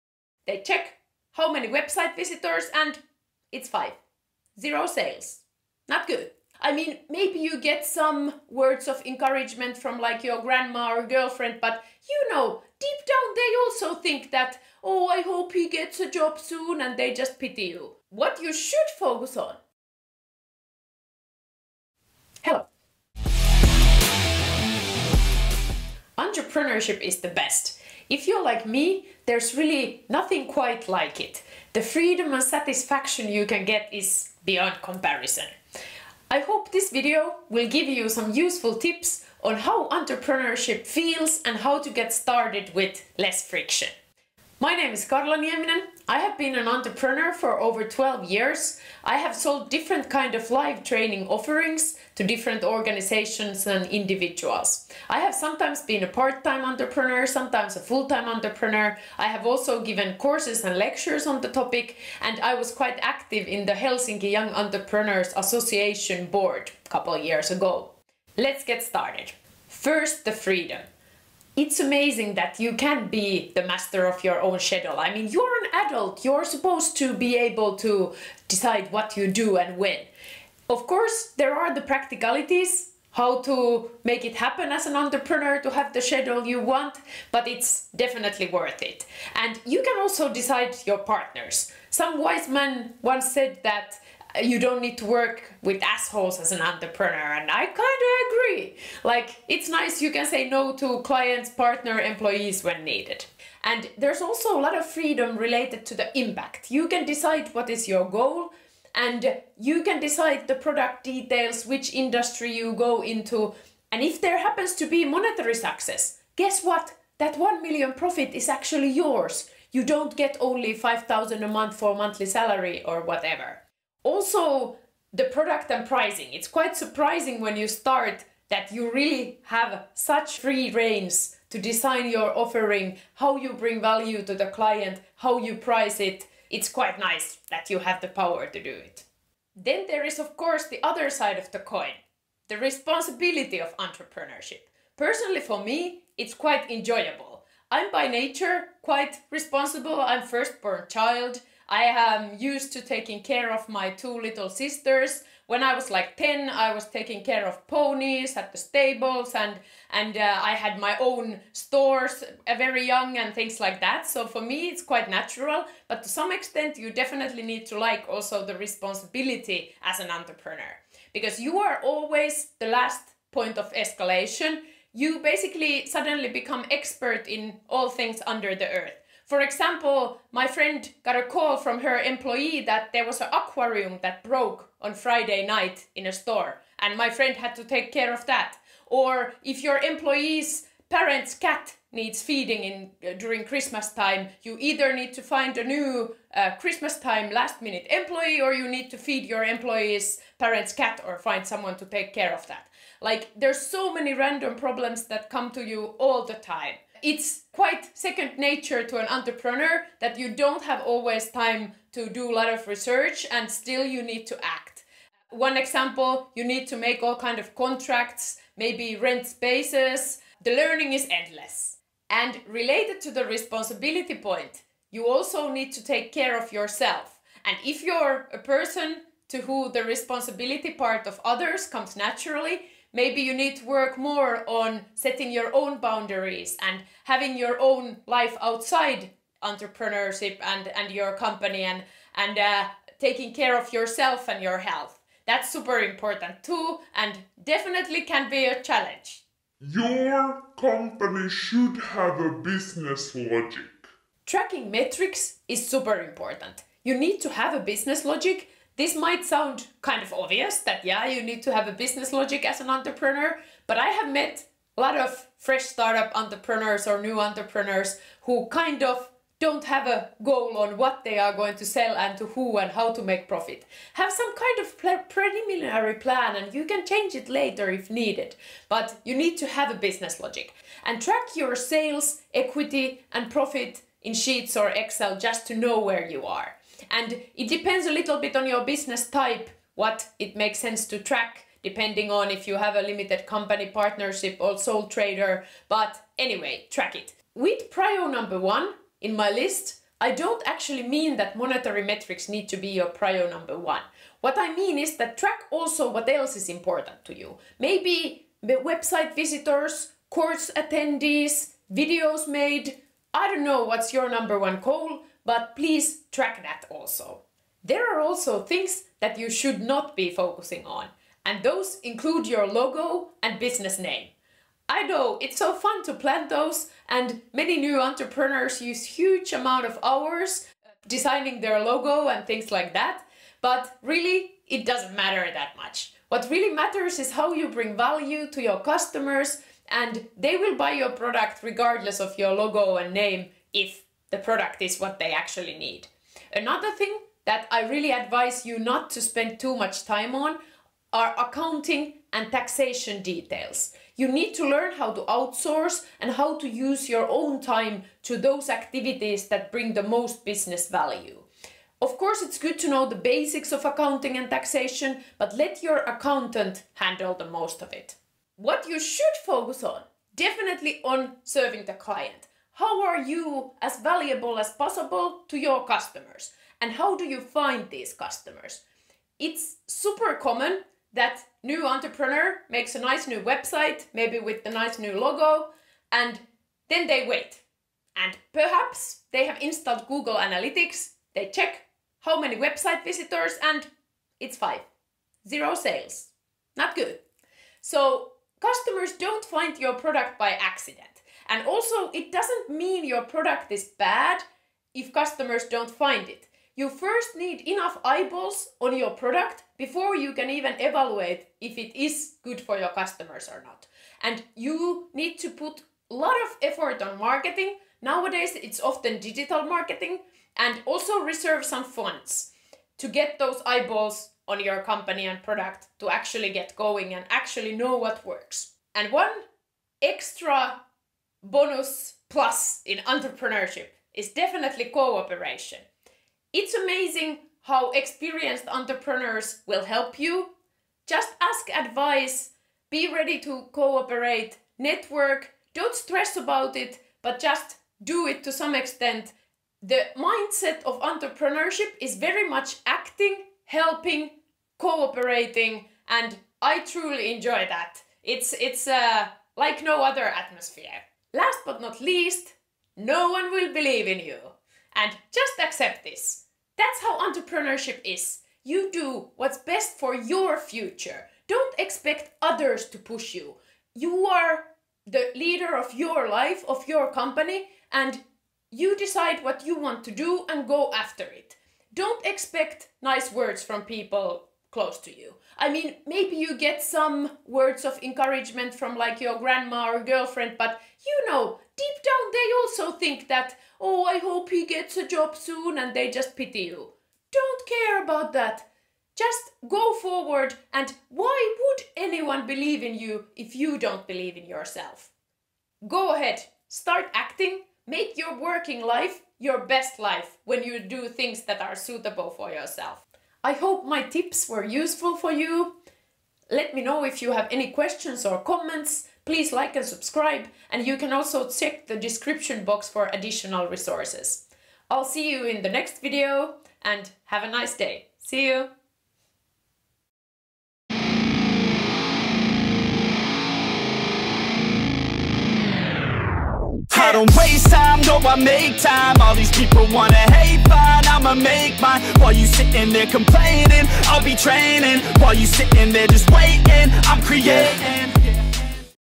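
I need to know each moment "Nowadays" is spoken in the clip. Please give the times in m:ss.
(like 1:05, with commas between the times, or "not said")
6:57.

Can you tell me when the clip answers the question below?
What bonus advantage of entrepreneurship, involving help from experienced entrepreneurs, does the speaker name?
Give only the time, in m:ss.
7:14.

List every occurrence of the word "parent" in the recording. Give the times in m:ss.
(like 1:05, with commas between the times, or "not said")
3:10, 3:20.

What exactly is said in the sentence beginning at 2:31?
I am used to taking care of my two little sisters.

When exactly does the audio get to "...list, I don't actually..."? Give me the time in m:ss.
4:59.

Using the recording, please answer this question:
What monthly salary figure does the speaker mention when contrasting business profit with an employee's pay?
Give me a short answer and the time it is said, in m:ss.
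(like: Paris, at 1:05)
5000, at 2:00.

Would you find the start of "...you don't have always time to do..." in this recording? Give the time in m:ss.
3:30.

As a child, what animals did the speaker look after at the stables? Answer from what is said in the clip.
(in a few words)
ponies.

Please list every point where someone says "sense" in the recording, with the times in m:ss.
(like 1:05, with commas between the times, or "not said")
4:50.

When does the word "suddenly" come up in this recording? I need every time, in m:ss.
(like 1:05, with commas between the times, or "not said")
2:55.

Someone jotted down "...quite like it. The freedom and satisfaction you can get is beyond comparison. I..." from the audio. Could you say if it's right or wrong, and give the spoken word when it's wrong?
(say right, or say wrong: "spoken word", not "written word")
right.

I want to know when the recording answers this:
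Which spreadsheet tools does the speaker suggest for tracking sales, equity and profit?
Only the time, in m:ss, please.
4:44.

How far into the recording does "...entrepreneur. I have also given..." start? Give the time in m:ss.
0:58.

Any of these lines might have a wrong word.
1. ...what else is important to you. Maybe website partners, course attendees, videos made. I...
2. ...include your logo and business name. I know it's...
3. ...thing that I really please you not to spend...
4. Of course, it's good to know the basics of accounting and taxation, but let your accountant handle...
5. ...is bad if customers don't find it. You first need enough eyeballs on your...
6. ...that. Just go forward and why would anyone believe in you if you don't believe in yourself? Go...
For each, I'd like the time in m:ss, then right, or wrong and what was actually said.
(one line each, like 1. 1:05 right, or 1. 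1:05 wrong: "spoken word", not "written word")
1. 5:05 wrong: "visitors", not "partners"
2. 5:21 right
3. 5:46 wrong: "advise", not "please"
4. 6:01 right
5. 6:43 right
6. 8:18 right.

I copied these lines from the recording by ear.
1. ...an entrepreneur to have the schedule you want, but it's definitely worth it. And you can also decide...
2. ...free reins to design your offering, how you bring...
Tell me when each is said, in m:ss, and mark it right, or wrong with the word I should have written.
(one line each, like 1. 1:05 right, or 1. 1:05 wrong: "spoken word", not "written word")
1. 1:24 right
2. 2:10 right.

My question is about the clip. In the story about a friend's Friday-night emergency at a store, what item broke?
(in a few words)
an aquarium.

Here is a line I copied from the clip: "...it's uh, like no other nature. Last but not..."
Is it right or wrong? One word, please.
wrong.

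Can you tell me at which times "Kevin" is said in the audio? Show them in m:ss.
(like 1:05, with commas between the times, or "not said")
not said.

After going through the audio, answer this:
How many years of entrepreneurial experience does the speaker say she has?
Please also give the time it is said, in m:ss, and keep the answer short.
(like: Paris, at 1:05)
over 12 years, at 0:47.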